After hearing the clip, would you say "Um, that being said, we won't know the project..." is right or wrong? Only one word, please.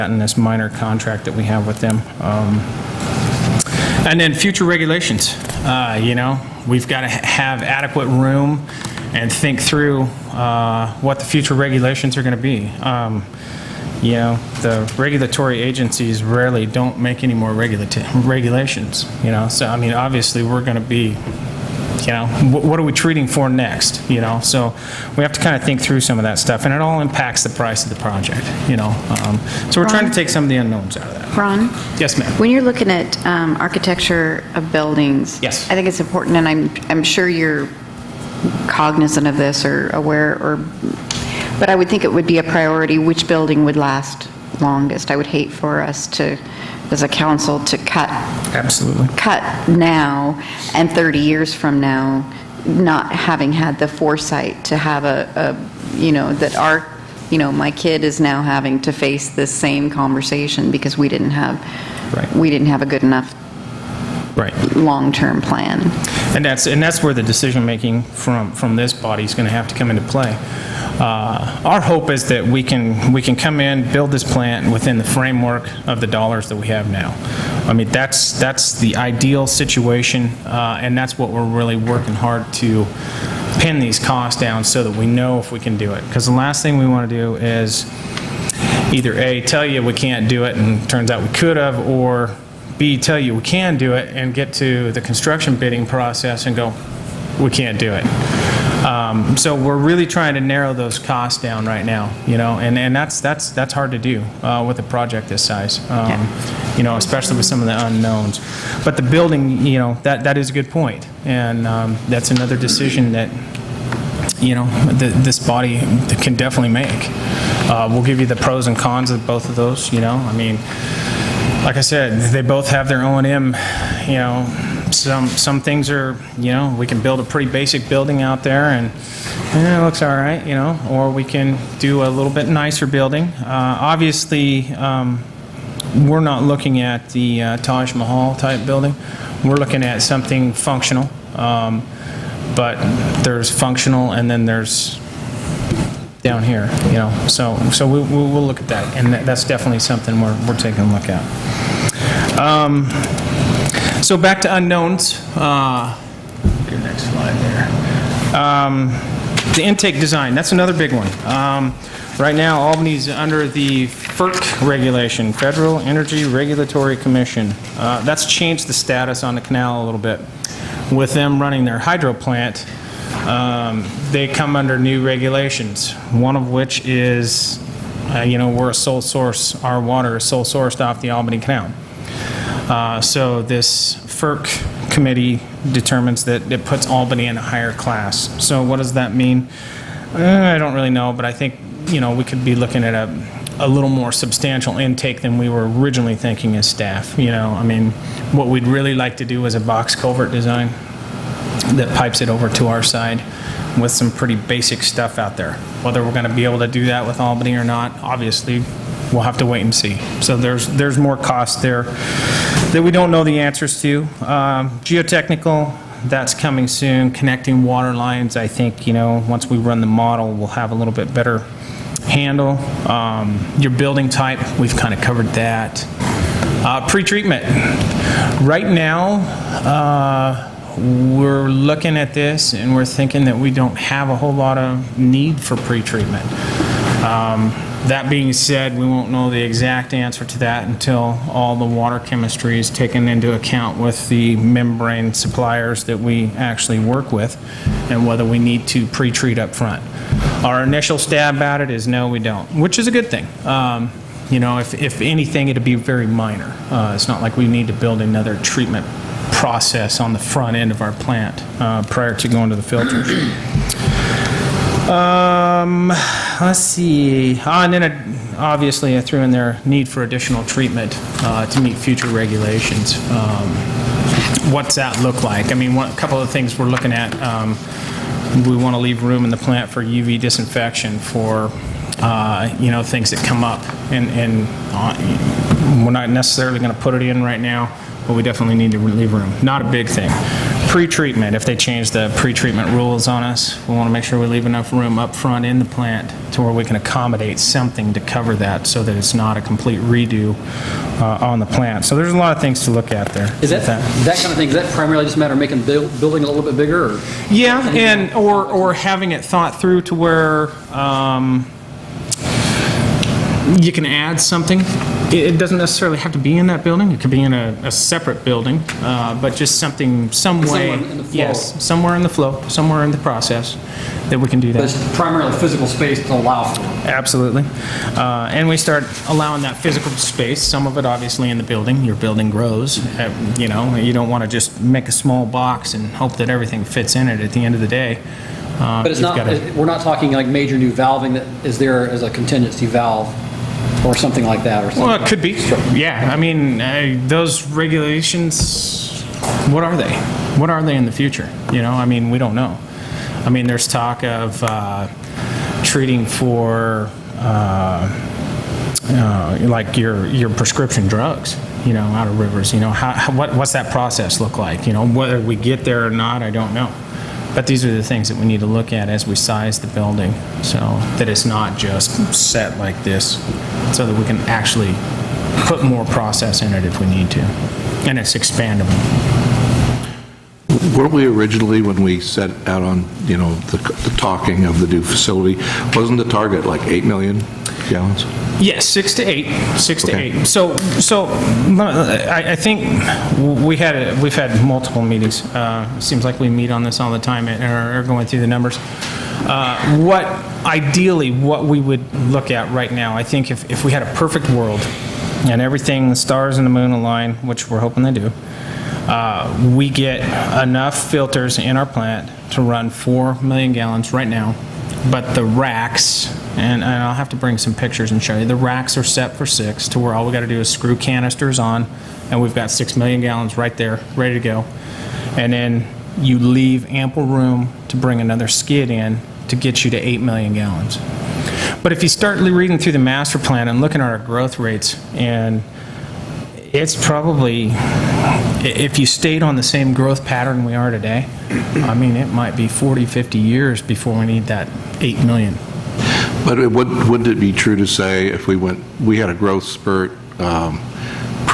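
wrong.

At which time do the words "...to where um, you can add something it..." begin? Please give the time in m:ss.
5:09.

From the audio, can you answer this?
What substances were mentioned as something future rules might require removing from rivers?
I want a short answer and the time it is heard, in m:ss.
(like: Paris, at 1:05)
prescription drugs, at 6:00.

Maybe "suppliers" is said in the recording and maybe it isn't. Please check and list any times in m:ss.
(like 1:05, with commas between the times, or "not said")
4:05.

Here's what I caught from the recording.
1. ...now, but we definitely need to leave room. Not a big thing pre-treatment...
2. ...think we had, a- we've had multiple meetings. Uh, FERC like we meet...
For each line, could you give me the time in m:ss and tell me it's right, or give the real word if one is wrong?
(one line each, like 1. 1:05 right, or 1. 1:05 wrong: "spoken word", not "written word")
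1. 4:47 right
2. 6:32 wrong: "Seems", not "FERC".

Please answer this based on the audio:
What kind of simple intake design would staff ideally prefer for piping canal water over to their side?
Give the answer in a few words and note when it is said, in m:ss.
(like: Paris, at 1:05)
box culvert, at 3:19.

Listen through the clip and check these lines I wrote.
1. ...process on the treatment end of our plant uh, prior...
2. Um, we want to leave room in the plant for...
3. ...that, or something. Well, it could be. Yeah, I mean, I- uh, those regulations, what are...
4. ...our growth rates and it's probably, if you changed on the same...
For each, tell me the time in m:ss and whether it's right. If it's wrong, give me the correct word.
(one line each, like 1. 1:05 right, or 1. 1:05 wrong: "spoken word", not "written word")
1. 4:19 wrong: "front", not "treatment"
2. 4:37 right
3. 5:44 right
4. 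7:13 wrong: "stayed", not "changed".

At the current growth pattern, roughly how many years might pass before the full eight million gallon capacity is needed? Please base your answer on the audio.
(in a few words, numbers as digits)
40 to 50 years.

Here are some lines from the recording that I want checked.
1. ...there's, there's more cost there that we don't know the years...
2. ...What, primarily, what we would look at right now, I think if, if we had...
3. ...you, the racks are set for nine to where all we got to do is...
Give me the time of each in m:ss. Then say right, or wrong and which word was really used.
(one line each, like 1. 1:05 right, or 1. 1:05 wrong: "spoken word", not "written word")
1. 3:30 wrong: "answers", not "years"
2. 6:39 wrong: "ideally", not "primarily"
3. 6:58 wrong: "six", not "nine".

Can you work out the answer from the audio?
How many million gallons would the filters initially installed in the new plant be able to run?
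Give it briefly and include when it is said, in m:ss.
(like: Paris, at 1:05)
4 million gallons, at 6:52.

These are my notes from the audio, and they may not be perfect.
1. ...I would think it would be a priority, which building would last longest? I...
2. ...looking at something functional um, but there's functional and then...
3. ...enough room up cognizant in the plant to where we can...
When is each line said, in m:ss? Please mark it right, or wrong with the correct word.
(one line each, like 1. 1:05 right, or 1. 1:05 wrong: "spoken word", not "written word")
1. 0:41 right
2. 2:19 right
3. 4:54 wrong: "front", not "cognizant".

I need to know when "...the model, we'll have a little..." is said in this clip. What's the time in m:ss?
3:39.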